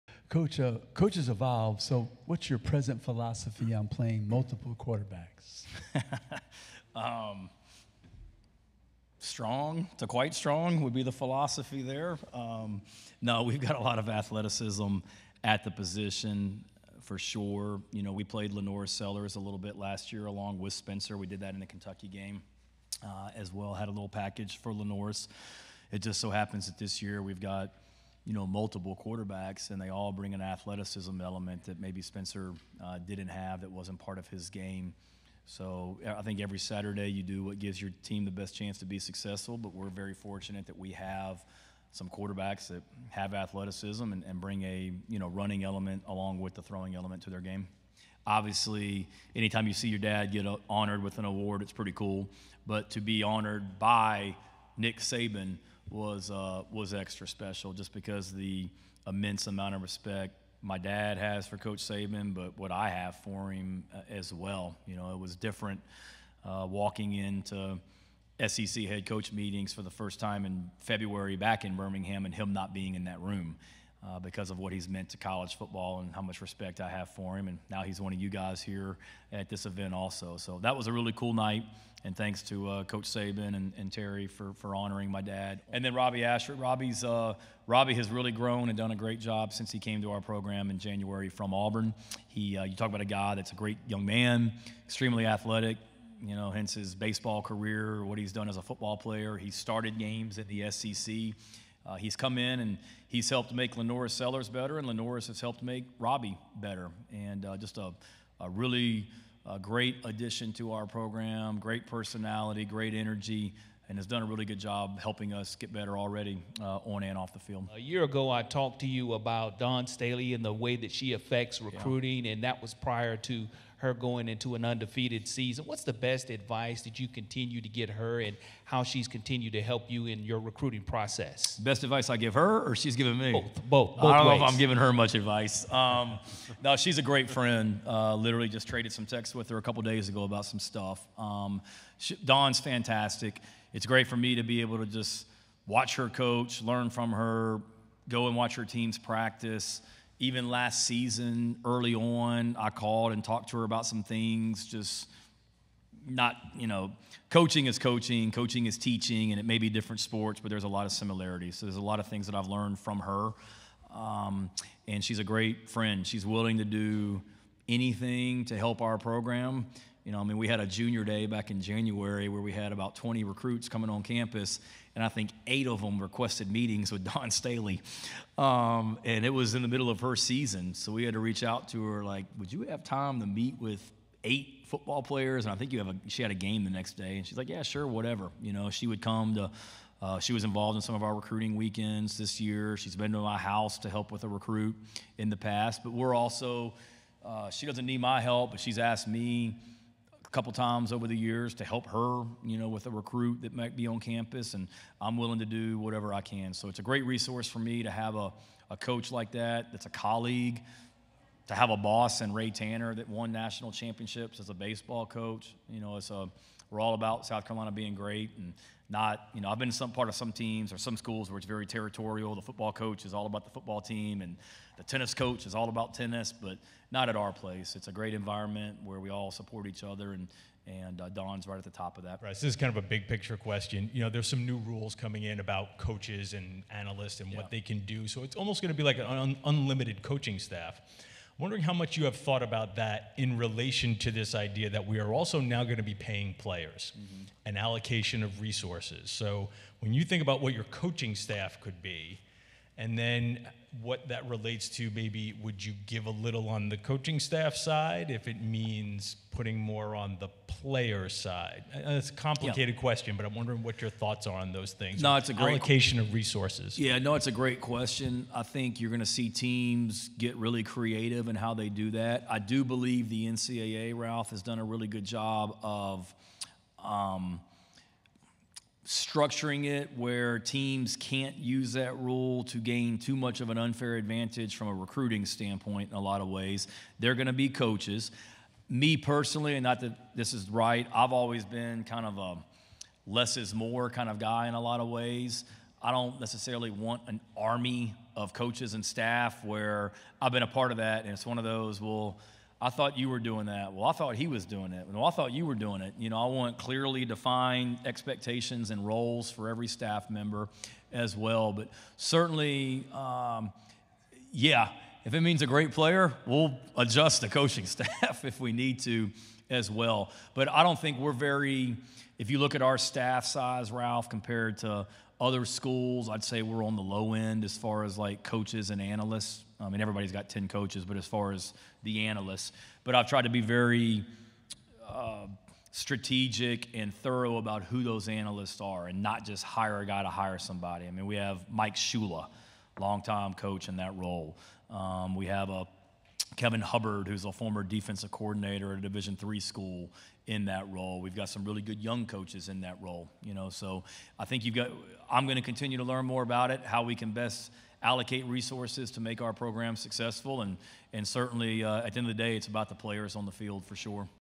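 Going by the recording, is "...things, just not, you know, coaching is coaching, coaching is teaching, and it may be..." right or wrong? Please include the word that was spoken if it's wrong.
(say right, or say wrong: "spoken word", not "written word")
right.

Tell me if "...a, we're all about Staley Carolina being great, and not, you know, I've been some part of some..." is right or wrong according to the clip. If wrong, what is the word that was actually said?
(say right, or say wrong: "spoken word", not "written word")
wrong: "South", not "Staley".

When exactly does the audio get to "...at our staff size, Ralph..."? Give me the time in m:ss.
5:22.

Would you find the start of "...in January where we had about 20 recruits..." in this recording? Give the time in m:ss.
2:51.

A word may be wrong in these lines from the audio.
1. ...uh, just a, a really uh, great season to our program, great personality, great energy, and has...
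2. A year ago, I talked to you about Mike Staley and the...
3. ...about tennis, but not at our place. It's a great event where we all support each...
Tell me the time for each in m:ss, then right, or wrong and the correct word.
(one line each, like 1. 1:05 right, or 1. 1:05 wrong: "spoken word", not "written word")
1. 1:47 wrong: "addition", not "season"
2. 1:57 wrong: "Dawn", not "Mike"
3. 3:45 wrong: "environment", not "event".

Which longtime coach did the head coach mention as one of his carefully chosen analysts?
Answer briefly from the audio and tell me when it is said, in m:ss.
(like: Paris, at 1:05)
Mike Shula, at 5:41.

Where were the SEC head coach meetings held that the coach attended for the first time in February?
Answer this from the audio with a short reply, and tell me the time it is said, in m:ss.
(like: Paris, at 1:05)
Birmingham, at 1:11.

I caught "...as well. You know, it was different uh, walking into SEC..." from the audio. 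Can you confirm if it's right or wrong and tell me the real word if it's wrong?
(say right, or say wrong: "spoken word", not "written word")
right.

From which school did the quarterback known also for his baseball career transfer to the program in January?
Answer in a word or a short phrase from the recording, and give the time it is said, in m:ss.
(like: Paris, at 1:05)
Auburn, at 1:31.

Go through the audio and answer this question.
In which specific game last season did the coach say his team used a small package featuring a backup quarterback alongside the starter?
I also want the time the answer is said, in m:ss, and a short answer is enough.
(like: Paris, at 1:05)
Kentucky, at 0:21.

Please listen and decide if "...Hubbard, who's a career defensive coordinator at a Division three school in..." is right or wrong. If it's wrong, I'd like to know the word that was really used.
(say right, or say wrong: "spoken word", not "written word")
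wrong: "former", not "career".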